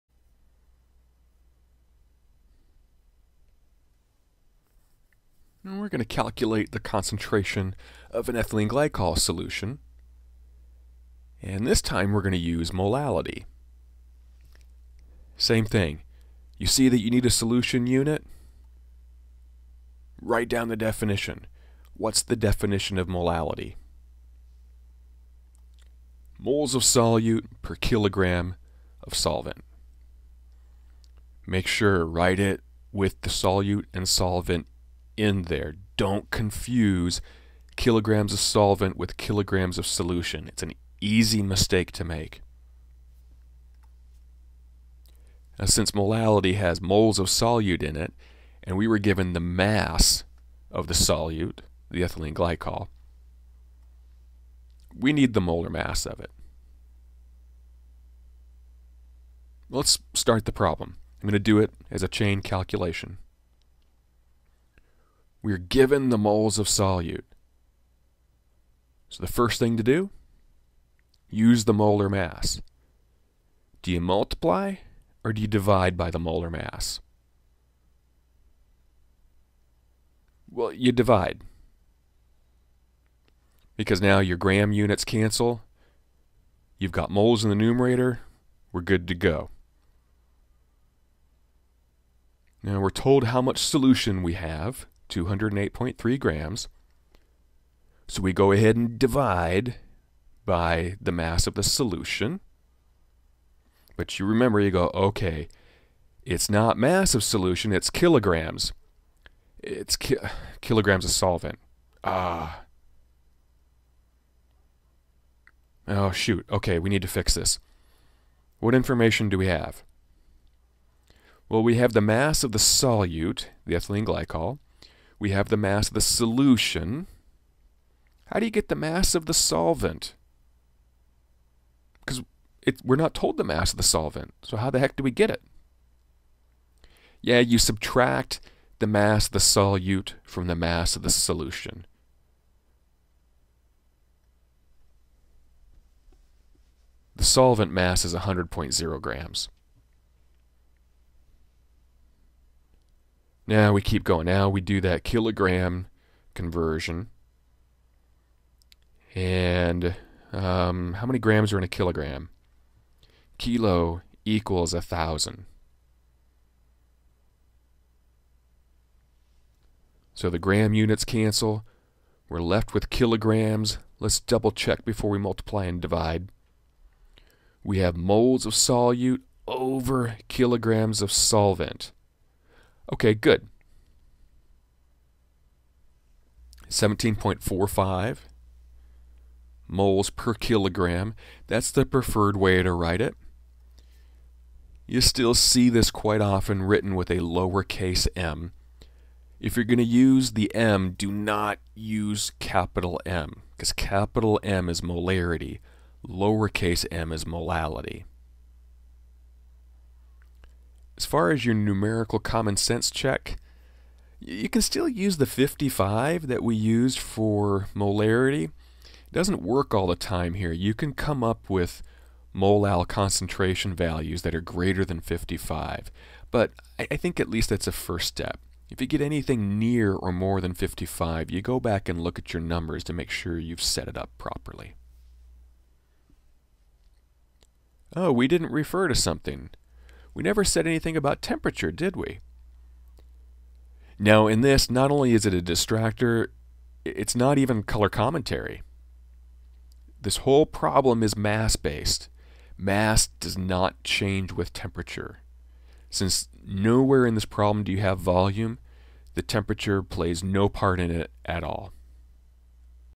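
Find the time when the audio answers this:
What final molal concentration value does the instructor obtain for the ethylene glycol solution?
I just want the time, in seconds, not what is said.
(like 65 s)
186 s.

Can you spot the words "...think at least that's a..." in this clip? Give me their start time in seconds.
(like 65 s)
226 s.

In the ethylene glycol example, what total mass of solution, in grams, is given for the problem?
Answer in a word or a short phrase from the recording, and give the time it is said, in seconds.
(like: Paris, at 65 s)
208.3 grams, at 95 s.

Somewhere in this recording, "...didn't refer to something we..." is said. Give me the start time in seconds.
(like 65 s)
238 s.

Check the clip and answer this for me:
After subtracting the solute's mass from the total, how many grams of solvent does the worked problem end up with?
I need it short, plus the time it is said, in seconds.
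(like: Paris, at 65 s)
100.0 grams, at 148 s.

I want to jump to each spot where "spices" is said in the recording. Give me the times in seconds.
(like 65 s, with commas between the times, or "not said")
not said.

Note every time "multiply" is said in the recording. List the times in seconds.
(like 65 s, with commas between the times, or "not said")
74 s, 175 s.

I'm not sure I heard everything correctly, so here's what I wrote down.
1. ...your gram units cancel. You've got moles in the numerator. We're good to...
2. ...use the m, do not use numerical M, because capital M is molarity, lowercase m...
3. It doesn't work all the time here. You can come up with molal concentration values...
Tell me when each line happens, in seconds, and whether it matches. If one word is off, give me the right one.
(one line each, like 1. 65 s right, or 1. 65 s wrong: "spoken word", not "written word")
1. 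84 s right
2. 199 s wrong: "capital", not "numerical"
3. 218 s right.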